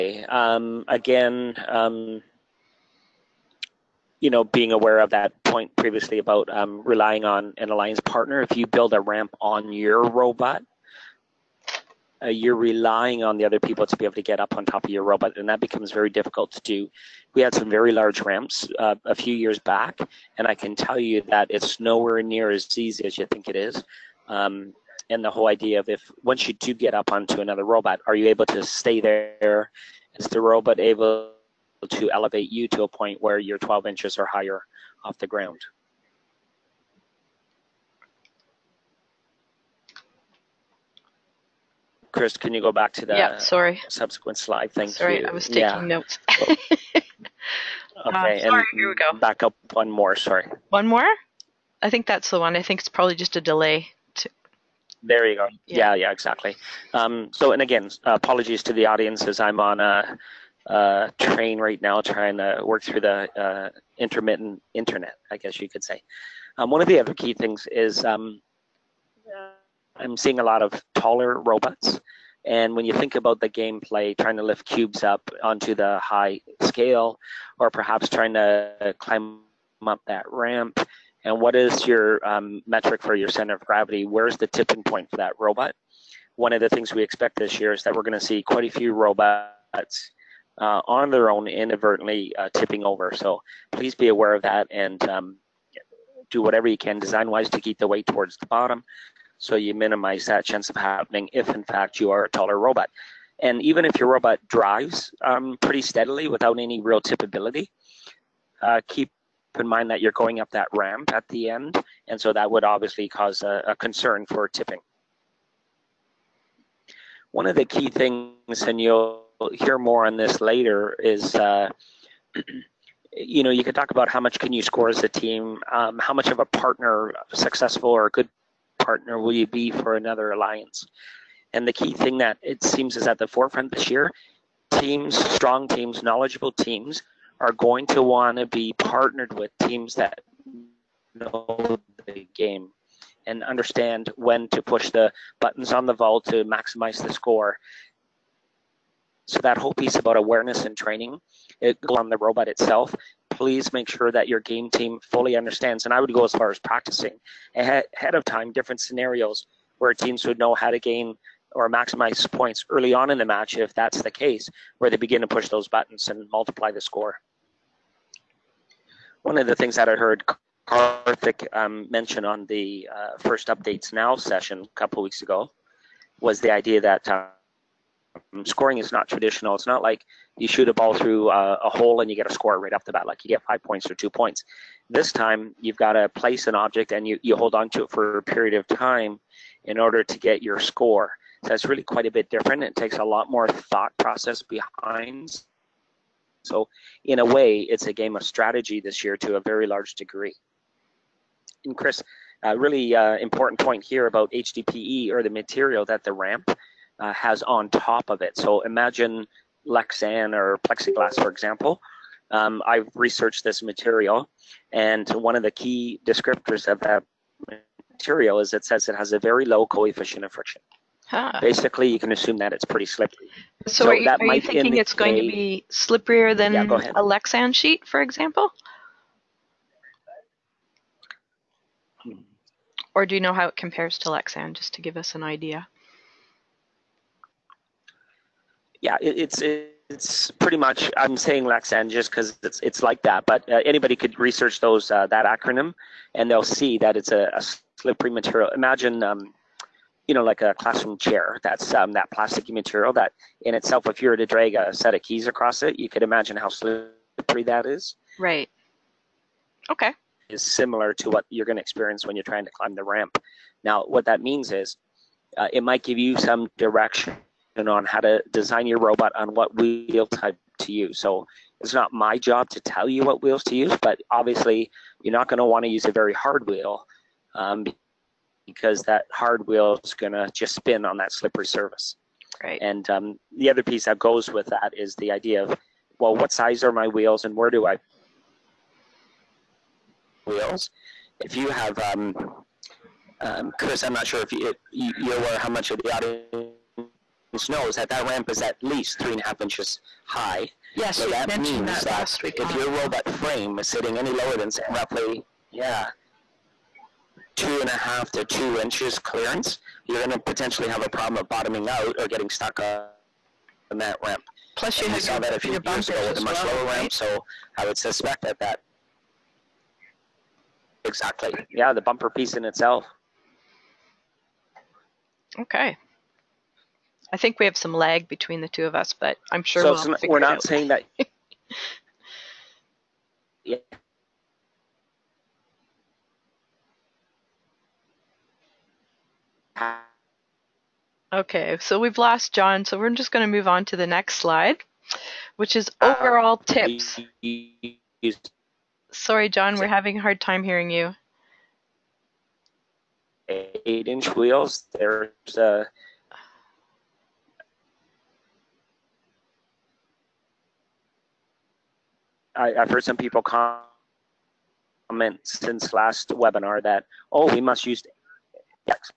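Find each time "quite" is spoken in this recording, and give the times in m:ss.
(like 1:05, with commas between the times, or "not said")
1:28, 3:11.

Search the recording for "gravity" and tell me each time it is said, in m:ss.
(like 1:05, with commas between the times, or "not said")
1:23.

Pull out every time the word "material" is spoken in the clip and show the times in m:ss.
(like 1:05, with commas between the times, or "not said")
3:25, 3:33, 3:37, 4:08, 4:12.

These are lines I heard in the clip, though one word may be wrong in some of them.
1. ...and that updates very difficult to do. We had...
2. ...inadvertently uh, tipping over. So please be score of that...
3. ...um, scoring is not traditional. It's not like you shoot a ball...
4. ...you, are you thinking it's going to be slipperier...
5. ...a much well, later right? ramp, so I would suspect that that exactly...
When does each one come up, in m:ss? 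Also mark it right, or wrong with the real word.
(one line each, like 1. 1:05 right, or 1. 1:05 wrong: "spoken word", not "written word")
1. 0:15 wrong: "becomes", not "updates"
2. 1:31 wrong: "aware", not "score"
3. 2:57 right
4. 3:43 right
5. 5:16 wrong: "lower", not "later".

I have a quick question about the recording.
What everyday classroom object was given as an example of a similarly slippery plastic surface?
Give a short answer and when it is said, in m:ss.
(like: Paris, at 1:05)
a classroom chair, at 4:10.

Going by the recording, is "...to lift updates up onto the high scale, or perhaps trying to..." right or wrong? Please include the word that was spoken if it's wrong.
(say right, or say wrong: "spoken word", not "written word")
wrong: "cubes", not "updates".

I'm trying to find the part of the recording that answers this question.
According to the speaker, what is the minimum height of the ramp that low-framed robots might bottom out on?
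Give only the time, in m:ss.
4:58.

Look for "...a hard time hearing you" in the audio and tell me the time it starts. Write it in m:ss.
5:49.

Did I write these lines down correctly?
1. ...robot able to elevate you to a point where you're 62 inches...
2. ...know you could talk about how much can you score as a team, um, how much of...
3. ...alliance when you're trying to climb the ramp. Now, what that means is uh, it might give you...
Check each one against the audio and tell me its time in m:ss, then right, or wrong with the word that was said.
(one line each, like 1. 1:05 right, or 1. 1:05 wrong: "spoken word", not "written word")
1. 0:30 wrong: "12", not "62"
2. 2:03 right
3. 4:21 wrong: "experience", not "alliance".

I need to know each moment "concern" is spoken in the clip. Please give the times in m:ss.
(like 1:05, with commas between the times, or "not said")
1:53.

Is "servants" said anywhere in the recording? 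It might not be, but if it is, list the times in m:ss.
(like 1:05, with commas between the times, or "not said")
not said.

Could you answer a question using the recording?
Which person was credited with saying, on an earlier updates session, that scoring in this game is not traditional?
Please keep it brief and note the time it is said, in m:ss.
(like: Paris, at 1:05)
Karthik, at 2:50.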